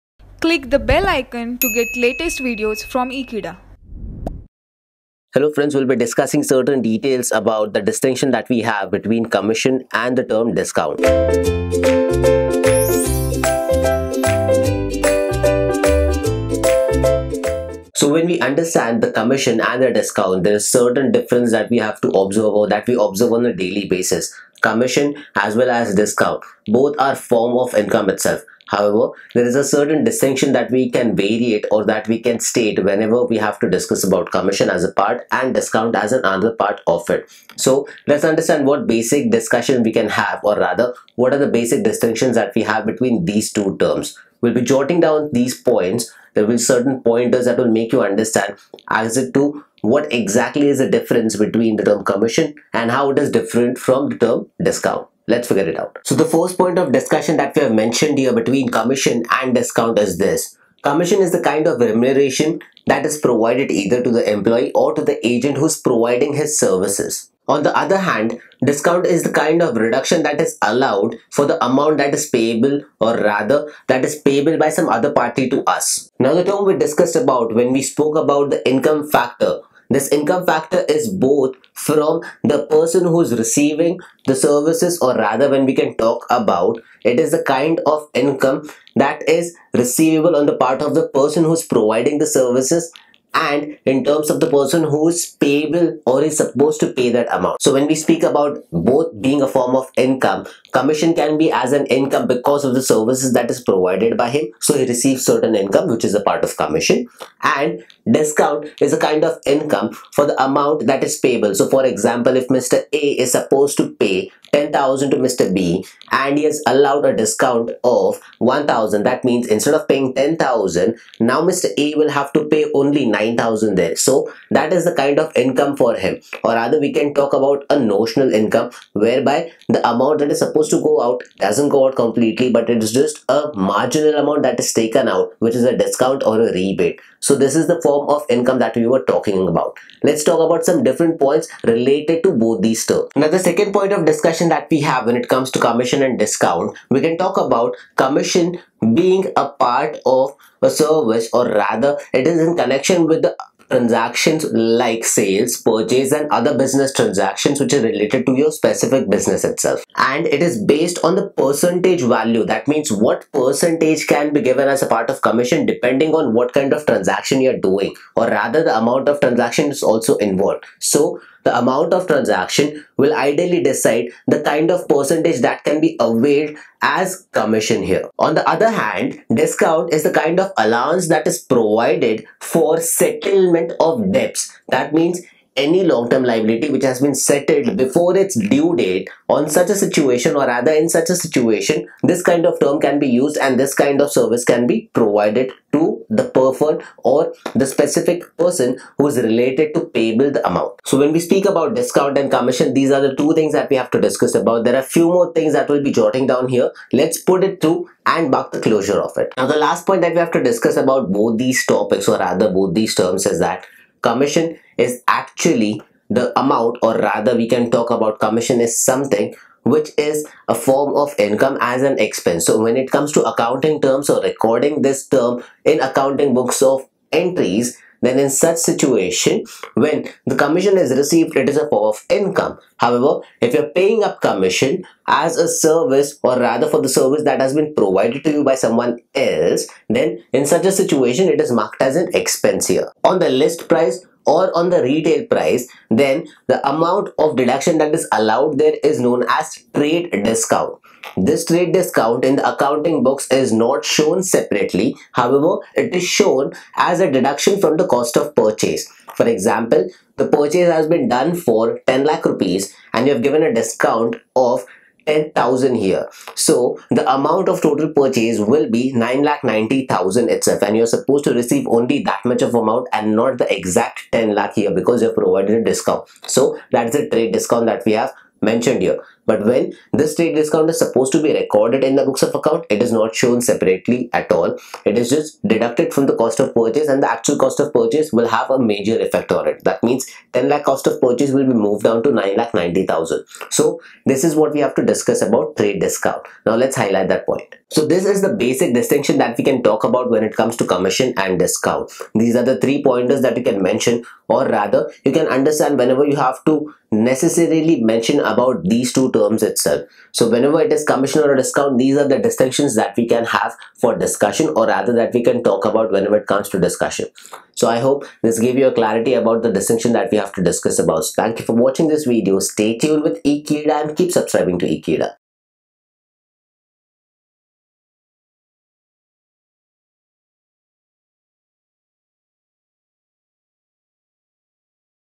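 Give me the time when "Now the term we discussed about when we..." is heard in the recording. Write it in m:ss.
1:16.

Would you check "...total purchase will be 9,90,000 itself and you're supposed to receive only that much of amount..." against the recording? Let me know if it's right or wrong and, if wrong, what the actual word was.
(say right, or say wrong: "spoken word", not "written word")
right.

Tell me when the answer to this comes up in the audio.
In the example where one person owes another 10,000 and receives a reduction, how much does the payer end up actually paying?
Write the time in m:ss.
2:03.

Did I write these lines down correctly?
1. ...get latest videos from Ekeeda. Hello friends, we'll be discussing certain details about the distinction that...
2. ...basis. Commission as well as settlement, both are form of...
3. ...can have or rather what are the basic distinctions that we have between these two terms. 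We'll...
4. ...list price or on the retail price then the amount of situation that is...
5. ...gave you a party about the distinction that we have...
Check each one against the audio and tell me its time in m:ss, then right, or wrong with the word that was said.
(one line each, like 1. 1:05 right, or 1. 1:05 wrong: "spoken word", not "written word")
1. 0:01 right
2. 0:23 wrong: "discount", not "settlement"
3. 0:39 right
4. 4:03 wrong: "deduction", not "situation"
5. 5:18 wrong: "clarity", not "party".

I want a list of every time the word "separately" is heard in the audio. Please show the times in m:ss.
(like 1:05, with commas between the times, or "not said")
4:14, 4:43.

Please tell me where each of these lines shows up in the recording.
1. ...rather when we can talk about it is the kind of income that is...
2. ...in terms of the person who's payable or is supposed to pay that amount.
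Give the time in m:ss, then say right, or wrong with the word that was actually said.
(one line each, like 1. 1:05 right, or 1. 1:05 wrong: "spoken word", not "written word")
1. 1:25 right
2. 1:33 right.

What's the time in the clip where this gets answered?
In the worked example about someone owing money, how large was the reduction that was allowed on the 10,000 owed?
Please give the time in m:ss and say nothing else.
1:58.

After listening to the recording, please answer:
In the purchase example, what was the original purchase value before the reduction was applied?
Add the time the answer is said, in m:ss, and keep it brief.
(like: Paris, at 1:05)
10 lakh rupees, at 4:21.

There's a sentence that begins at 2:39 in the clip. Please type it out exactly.
And it is based on the percentage value.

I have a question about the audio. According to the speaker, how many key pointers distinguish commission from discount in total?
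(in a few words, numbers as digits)
3.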